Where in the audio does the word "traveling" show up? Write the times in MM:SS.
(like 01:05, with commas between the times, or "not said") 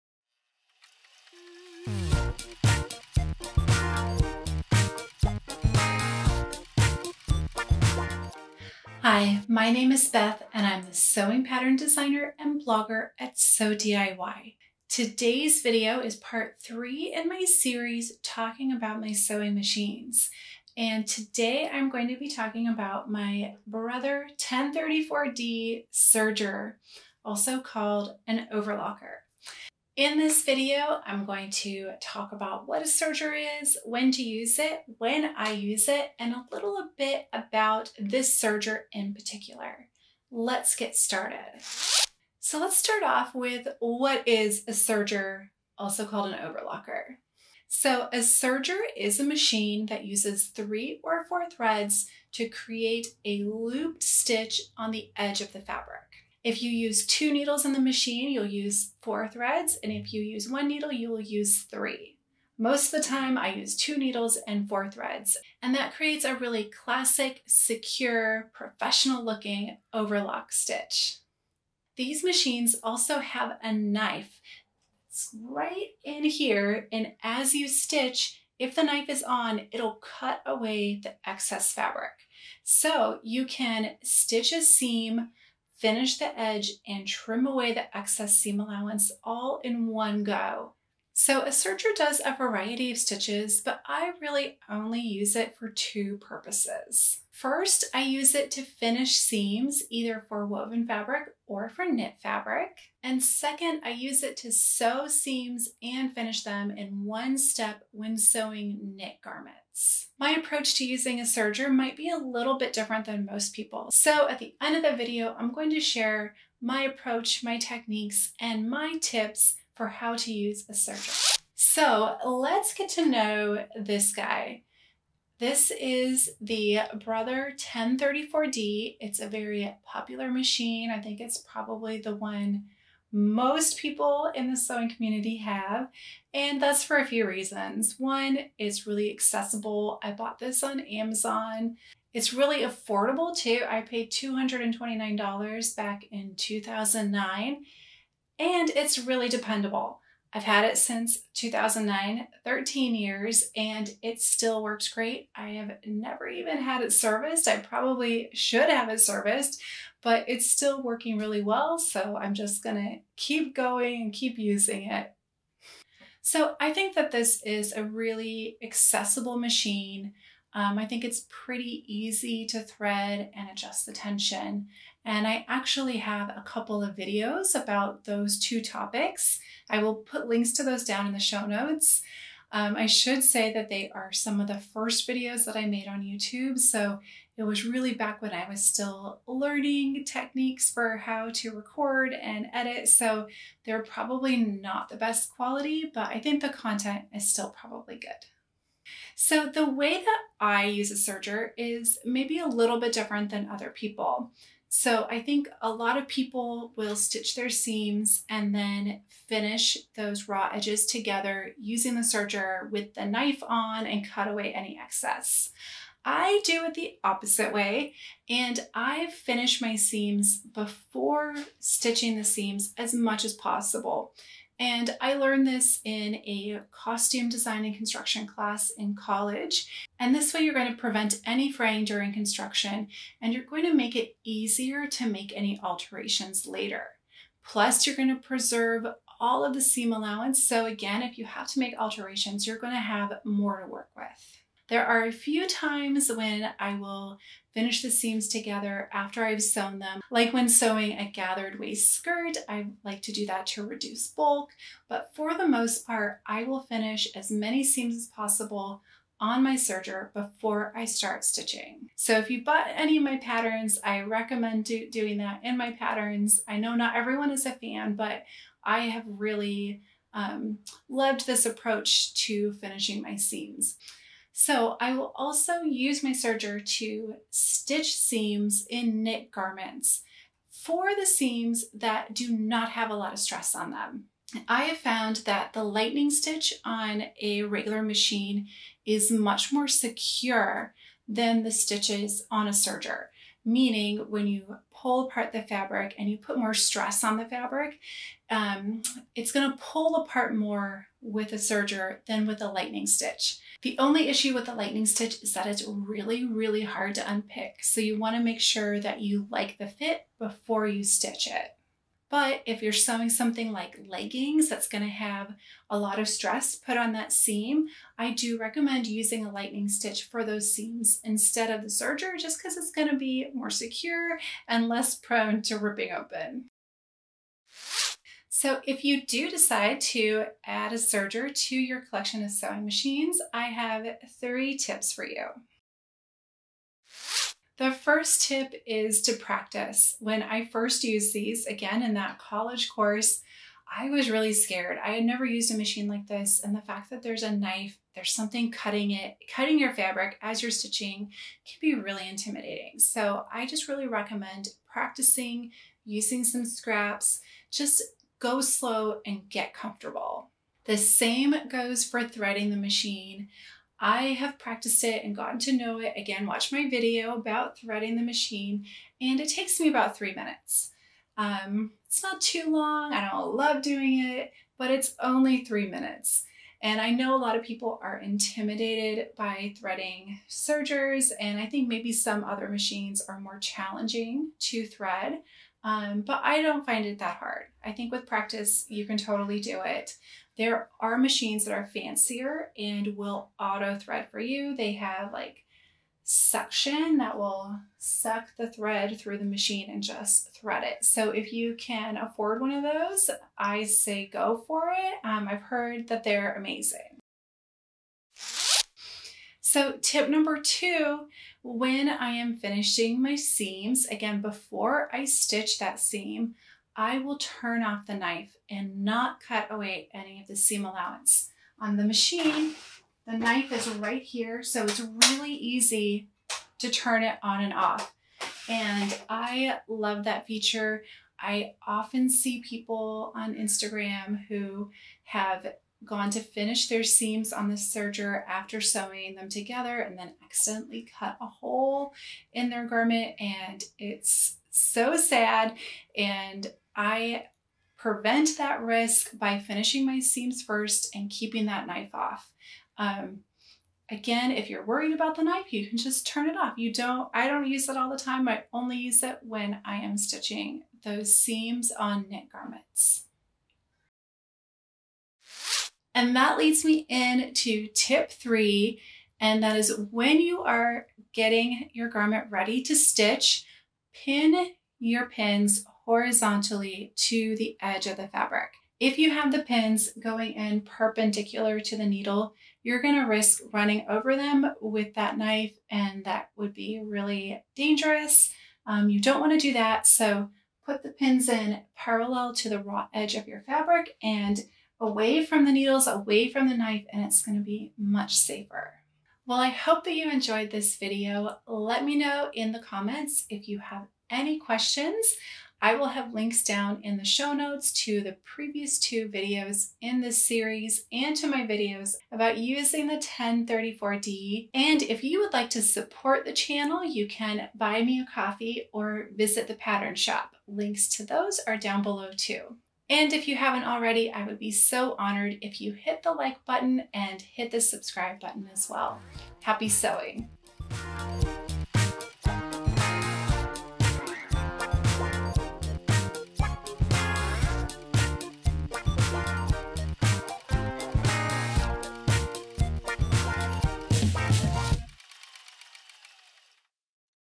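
not said.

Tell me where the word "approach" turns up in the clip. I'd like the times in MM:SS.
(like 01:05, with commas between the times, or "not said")
01:50, 01:56, 04:31.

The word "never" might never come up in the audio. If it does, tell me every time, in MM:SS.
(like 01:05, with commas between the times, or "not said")
02:35, 05:45.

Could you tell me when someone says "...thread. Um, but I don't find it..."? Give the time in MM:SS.
06:24.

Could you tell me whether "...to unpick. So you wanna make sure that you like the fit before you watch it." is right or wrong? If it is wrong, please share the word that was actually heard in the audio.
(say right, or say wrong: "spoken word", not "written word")
wrong: "stitch", not "watch".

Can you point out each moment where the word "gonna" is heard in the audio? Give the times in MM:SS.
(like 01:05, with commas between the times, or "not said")
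02:42, 08:17.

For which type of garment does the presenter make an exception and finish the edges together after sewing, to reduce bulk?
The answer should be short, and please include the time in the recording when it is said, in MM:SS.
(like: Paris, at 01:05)
gathered waist skirt, at 04:11.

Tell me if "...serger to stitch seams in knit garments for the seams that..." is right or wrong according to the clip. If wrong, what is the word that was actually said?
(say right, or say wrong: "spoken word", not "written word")
right.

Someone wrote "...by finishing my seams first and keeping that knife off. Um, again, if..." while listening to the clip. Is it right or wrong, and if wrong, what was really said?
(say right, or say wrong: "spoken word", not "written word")
right.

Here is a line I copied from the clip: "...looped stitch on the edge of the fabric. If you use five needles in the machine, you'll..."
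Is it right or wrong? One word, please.
wrong.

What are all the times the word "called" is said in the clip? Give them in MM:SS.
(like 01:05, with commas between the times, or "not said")
00:27, 00:46.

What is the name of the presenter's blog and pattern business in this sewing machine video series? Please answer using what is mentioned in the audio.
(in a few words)
Sew DIY.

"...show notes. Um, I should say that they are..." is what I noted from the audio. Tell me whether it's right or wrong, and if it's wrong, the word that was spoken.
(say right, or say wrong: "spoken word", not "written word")
right.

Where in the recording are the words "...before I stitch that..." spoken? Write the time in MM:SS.
06:54.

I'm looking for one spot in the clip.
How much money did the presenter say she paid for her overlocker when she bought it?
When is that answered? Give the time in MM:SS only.
02:24.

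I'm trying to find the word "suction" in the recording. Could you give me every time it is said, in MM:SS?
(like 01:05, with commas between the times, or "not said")
06:36.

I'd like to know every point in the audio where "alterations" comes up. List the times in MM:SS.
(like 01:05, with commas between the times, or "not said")
03:55, 04:01.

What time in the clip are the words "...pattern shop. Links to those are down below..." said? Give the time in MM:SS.
08:39.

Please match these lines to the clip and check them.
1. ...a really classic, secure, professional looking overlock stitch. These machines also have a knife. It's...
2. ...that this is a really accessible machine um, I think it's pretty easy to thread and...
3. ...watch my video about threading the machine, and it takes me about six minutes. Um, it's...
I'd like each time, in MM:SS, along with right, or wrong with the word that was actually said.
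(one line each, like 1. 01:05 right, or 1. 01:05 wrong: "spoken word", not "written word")
1. 01:06 right
2. 02:46 right
3. 06:06 wrong: "three", not "six".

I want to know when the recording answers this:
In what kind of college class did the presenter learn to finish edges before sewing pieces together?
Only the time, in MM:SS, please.
03:46.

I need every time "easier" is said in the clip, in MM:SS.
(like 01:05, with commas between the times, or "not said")
03:54.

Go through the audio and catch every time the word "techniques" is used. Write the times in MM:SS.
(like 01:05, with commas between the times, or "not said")
01:57, 03:10.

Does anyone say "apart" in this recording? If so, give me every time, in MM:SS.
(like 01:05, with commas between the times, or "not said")
04:55, 04:59.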